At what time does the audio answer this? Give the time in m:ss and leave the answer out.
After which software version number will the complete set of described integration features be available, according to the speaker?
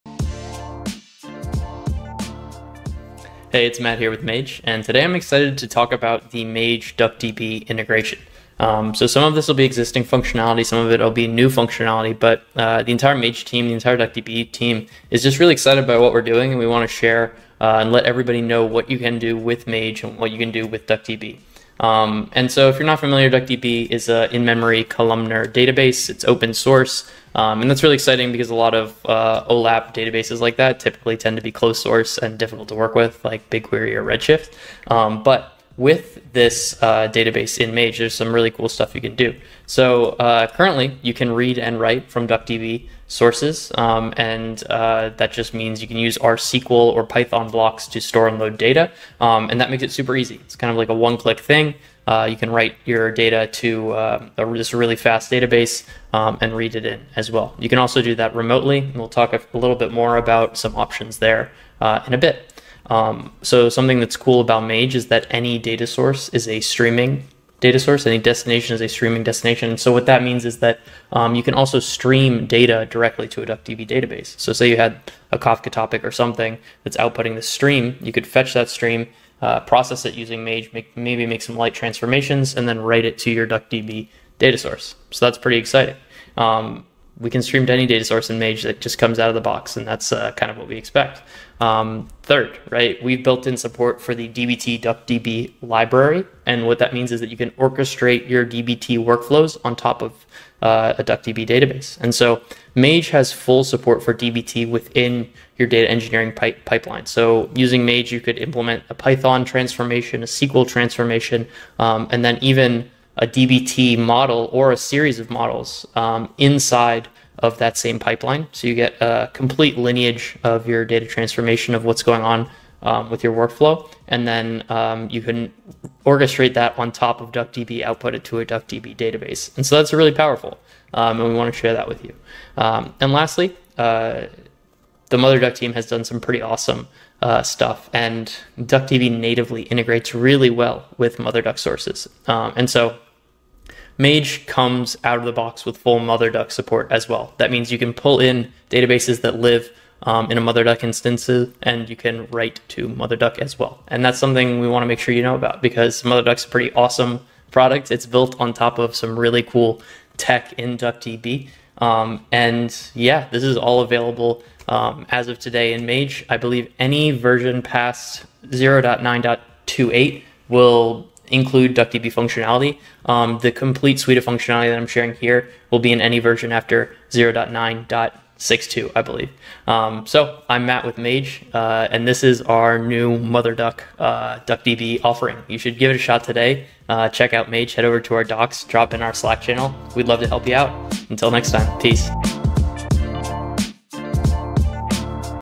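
2:57.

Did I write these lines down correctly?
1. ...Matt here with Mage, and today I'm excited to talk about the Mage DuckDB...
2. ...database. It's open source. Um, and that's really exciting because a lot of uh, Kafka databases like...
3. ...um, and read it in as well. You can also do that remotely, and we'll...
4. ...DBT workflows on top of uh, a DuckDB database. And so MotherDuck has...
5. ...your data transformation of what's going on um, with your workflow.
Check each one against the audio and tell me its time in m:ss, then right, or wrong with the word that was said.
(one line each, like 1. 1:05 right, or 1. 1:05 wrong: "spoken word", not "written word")
1. 0:03 right
2. 0:25 wrong: "OLAP", not "Kafka"
3. 0:56 right
4. 1:38 wrong: "Mage", not "MotherDuck"
5. 2:00 right.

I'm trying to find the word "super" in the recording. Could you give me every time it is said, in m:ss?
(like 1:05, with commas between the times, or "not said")
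0:49.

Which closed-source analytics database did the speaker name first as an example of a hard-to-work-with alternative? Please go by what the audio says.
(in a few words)
BigQuery.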